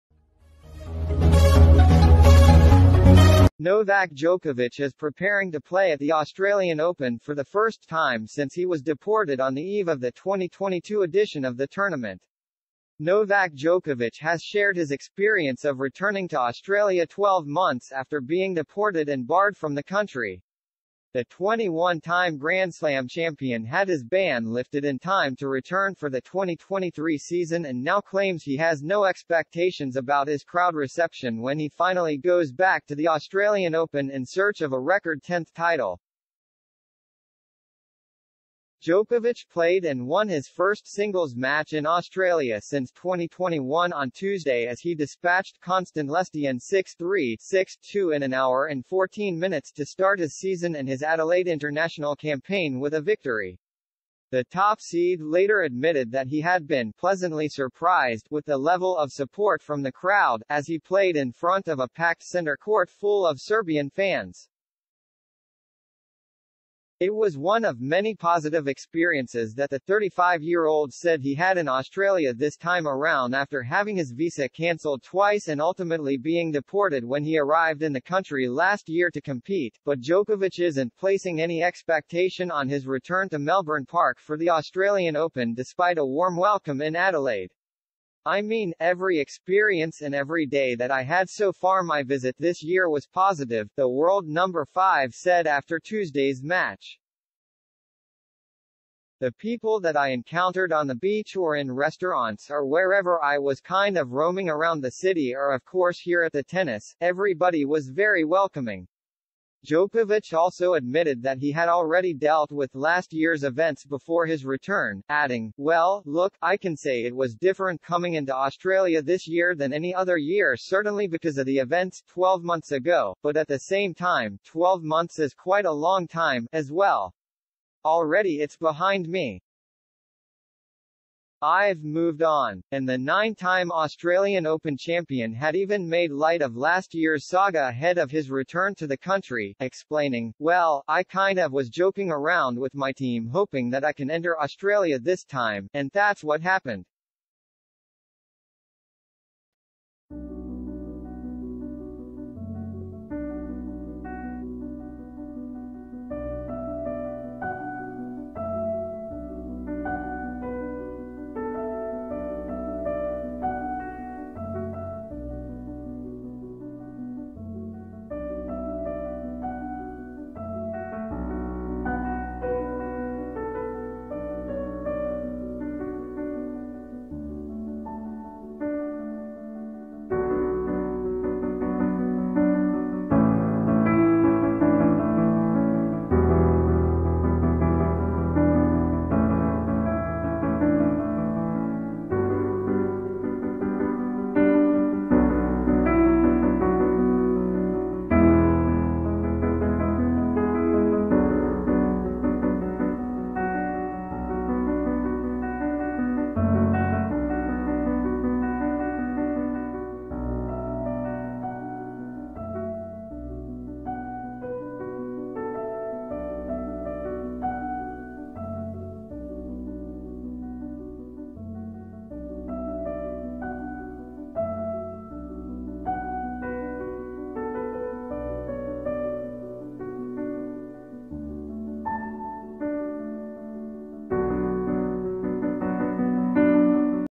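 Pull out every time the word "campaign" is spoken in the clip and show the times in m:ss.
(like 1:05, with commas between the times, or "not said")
0:52.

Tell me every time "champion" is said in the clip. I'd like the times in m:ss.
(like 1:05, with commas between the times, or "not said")
0:23, 2:14.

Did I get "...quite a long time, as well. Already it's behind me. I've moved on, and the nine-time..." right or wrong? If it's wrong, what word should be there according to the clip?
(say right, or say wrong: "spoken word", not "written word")
right.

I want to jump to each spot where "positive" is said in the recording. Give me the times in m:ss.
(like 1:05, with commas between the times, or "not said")
1:08, 1:33.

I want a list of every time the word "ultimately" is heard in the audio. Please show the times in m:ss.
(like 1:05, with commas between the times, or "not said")
1:15.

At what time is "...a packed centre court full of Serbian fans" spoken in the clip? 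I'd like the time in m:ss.
1:01.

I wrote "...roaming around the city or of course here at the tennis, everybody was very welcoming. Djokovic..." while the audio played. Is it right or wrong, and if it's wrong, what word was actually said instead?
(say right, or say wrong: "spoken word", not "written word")
right.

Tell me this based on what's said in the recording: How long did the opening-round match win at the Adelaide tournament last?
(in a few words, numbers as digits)
1 hour and 14 minutes.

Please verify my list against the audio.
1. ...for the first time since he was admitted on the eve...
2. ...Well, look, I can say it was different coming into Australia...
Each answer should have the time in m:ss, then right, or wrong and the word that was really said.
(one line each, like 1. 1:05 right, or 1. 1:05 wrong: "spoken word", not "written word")
1. 0:07 wrong: "deported", not "admitted"
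2. 1:55 right.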